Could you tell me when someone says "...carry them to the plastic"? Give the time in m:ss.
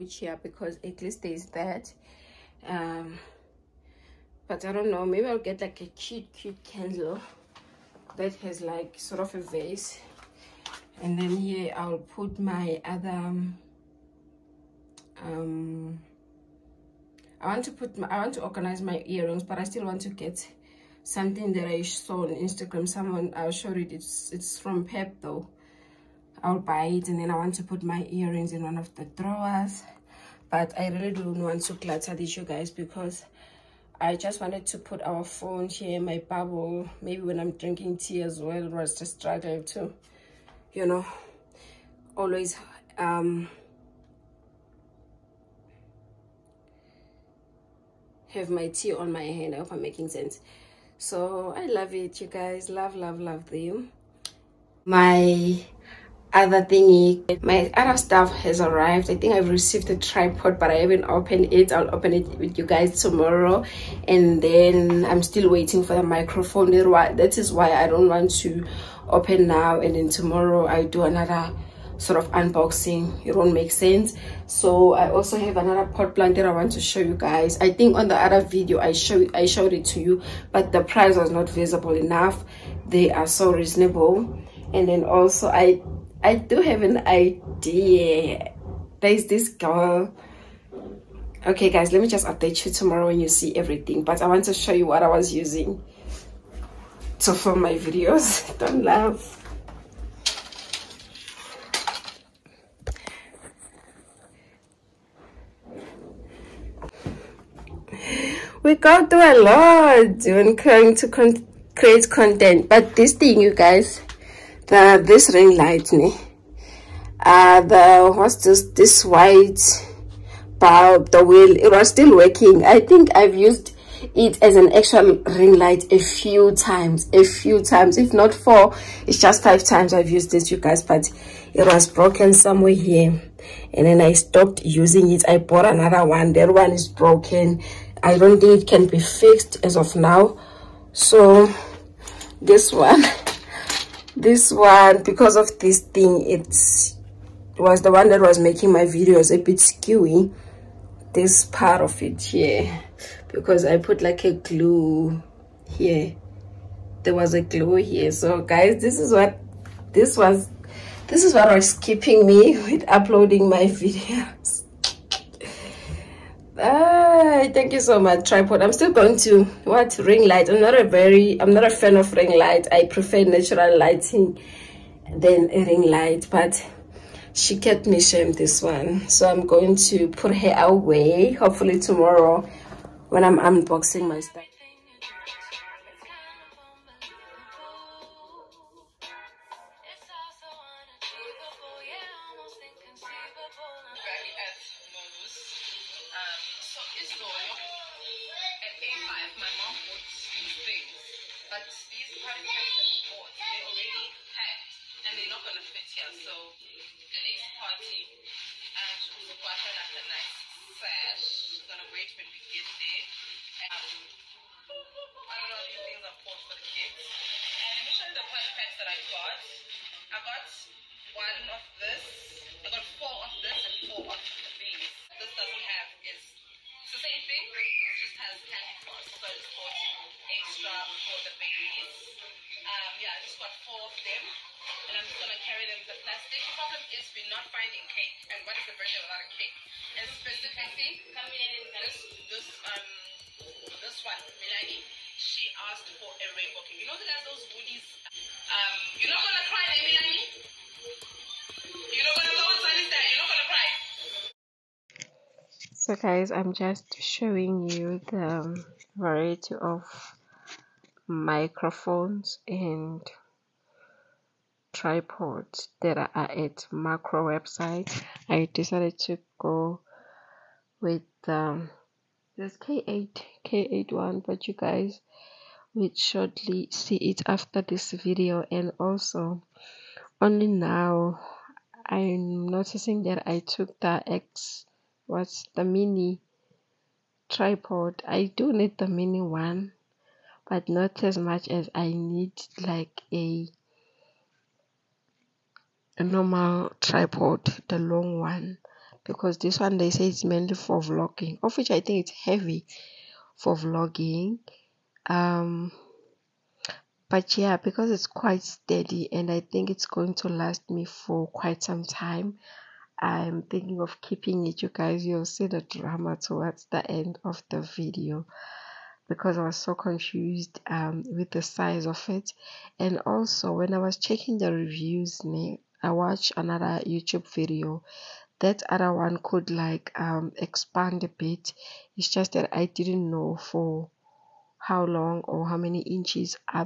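3:55.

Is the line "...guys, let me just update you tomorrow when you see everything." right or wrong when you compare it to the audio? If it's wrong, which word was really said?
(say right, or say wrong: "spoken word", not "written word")
right.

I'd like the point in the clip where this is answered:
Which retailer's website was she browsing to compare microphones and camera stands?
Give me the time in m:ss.
4:26.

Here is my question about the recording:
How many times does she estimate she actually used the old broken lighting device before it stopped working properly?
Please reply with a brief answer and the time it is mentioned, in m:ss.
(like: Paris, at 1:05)
5, at 2:09.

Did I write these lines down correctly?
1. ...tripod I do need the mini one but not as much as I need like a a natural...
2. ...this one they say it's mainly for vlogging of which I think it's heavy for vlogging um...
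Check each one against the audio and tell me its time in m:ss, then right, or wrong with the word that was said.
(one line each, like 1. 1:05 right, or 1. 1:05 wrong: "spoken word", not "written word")
1. 4:47 wrong: "normal", not "natural"
2. 4:59 right.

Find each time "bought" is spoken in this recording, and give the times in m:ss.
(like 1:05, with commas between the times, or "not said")
2:15, 3:49.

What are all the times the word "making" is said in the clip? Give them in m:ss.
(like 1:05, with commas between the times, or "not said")
0:49, 2:28.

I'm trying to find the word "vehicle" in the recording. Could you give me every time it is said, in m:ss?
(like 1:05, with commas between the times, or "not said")
not said.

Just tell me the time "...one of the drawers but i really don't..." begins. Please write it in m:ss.
0:28.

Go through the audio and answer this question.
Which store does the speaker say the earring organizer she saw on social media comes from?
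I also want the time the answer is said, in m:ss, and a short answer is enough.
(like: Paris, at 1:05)
Pep, at 0:24.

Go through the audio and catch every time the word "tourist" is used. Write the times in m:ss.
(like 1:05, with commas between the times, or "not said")
not said.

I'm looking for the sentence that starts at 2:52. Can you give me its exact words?
I prefer natural lighting than a ring light, but she kept me shamed this one.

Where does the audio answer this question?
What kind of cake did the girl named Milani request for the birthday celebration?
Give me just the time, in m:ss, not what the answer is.
4:06.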